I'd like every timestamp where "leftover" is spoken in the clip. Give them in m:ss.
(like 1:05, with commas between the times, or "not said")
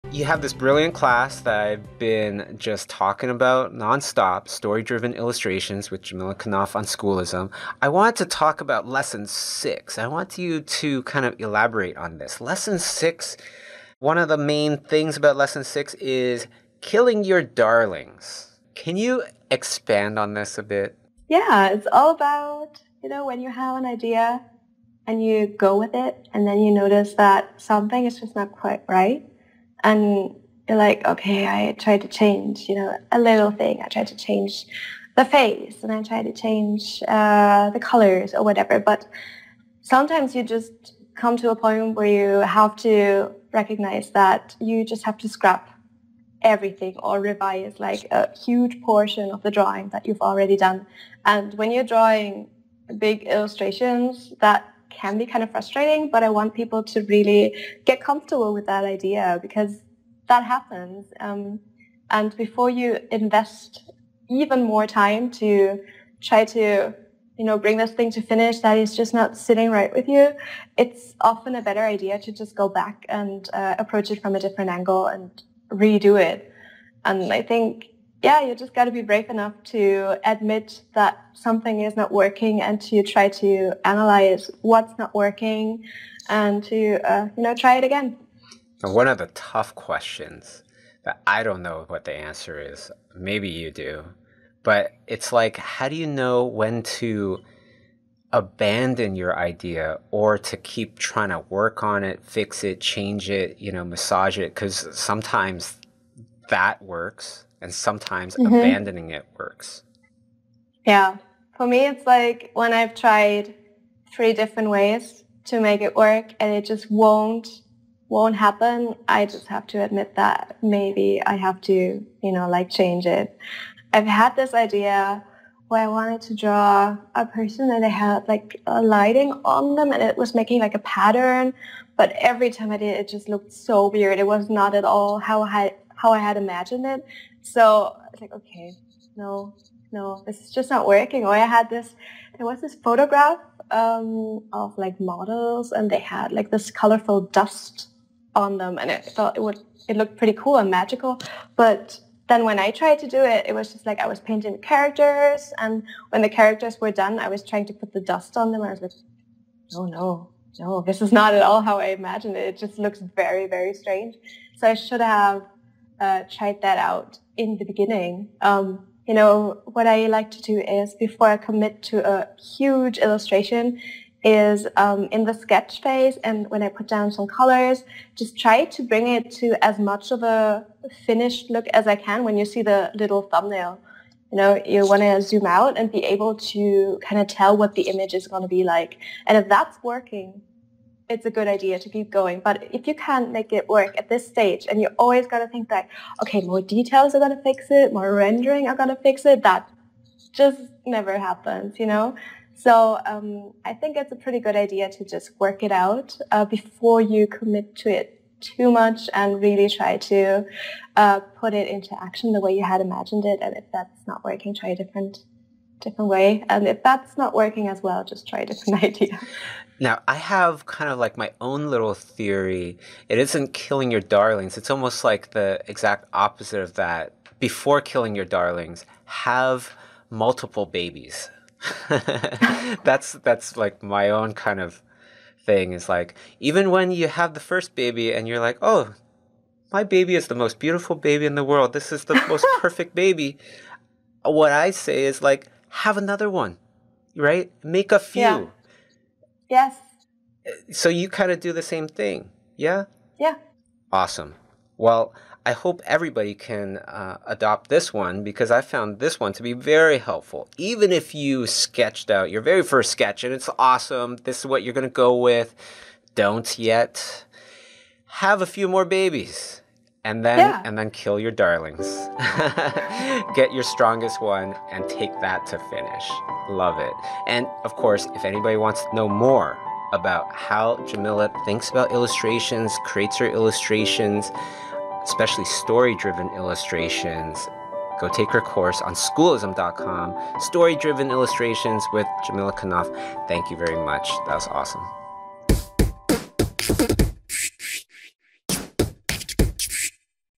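not said.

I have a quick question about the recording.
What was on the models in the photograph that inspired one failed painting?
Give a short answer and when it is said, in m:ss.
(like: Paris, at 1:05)
colorful dust, at 2:26.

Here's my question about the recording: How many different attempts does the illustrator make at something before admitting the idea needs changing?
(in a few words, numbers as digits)
3.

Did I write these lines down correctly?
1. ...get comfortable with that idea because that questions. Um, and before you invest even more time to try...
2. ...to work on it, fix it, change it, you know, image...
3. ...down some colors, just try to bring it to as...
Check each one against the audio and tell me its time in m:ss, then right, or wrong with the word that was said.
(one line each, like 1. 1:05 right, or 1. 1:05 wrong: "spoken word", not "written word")
1. 0:57 wrong: "happens", not "questions"
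2. 1:41 wrong: "massage", not "image"
3. 2:56 right.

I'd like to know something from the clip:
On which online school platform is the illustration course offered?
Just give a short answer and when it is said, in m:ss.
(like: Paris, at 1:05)
Schoolism, at 0:06.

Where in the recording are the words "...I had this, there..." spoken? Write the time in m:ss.
2:21.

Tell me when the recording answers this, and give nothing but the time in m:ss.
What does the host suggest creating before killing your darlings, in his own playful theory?
3:50.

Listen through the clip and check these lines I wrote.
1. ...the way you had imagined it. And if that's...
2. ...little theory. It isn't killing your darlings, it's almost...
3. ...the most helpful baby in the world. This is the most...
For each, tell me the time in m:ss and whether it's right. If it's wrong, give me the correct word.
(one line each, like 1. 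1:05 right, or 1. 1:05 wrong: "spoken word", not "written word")
1. 3:32 right
2. 3:41 right
3. 4:00 wrong: "beautiful", not "helpful".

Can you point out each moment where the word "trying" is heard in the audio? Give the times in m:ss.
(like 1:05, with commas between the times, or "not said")
1:40, 2:37.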